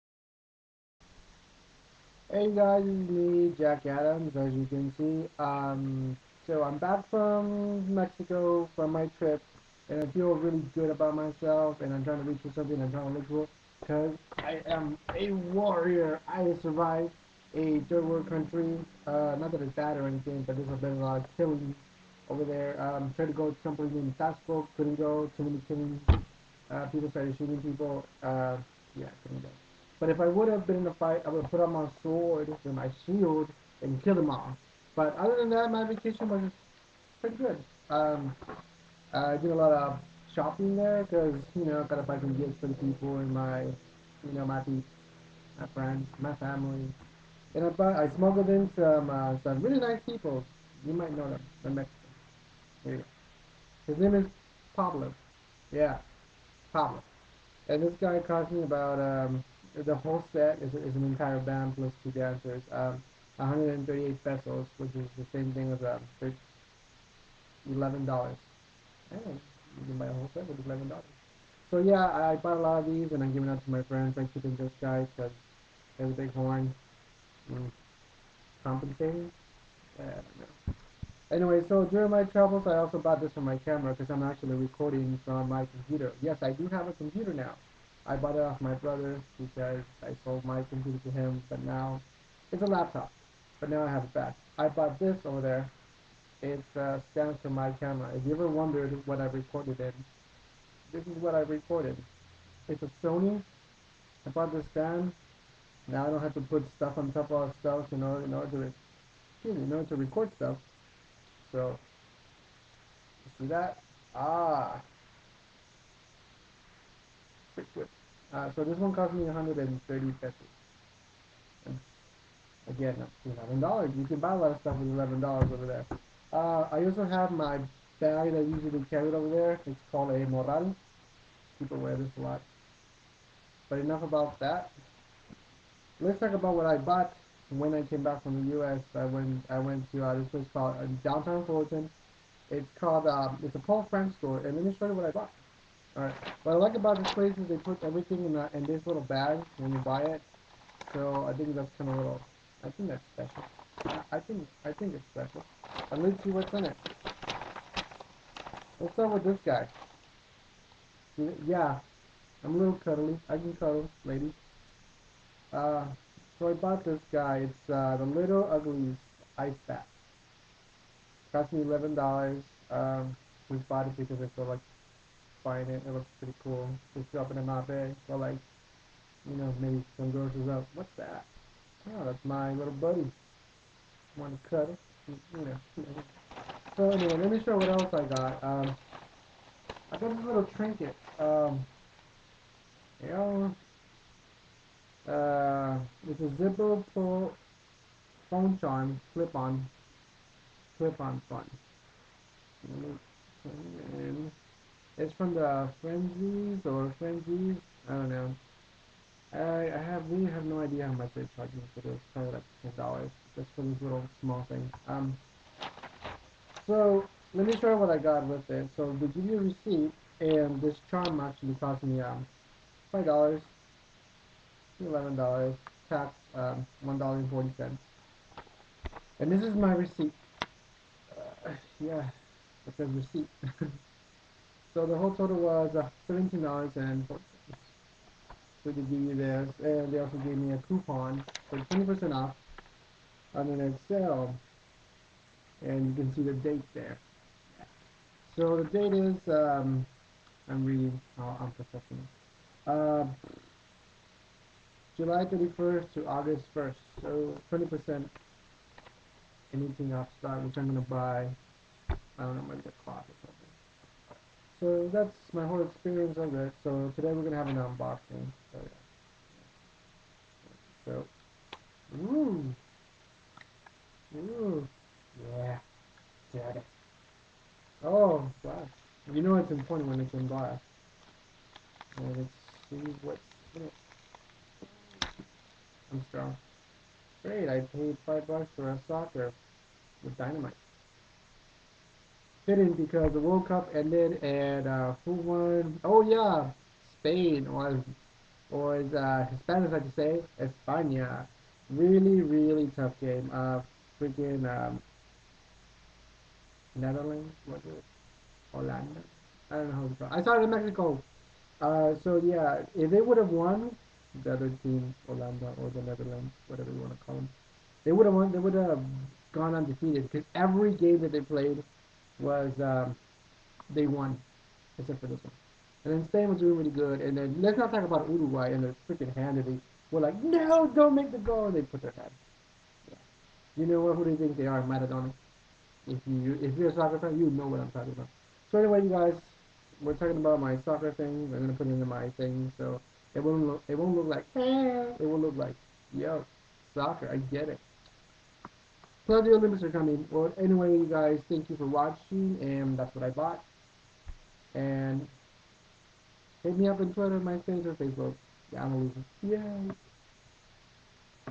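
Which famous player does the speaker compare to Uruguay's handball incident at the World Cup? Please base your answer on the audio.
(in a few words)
Maradona.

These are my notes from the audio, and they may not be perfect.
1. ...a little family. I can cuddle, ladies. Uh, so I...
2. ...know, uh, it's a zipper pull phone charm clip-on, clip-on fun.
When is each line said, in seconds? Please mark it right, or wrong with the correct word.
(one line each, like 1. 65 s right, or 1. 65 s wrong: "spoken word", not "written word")
1. 162 s wrong: "cuddly", not "family"
2. 193 s right.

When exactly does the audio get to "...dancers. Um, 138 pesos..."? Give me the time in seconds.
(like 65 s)
62 s.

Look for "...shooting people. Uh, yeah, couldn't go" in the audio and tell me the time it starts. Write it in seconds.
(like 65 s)
27 s.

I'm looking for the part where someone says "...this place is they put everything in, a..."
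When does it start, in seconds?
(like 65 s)
147 s.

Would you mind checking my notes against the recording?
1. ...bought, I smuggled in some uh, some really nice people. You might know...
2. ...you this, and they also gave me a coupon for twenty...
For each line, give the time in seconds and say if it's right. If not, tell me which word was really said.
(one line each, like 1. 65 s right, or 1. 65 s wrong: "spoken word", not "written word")
1. 47 s right
2. 238 s right.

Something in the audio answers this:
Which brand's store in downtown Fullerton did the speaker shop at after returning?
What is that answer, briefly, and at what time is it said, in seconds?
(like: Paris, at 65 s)
Paul Frank, at 143 s.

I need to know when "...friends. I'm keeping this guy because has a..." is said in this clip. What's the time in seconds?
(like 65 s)
73 s.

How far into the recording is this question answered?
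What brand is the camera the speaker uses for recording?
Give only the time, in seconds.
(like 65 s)
103 s.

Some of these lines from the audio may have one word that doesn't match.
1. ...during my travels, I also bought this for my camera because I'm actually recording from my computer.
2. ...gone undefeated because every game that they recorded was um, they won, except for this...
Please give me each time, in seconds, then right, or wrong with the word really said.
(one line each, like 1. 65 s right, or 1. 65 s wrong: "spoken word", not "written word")
1. 81 s right
2. 319 s wrong: "played", not "recorded".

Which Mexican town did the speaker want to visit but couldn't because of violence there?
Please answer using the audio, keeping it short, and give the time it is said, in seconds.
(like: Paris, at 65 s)
Taxco, at 24 s.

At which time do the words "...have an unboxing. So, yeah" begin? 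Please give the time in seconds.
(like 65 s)
267 s.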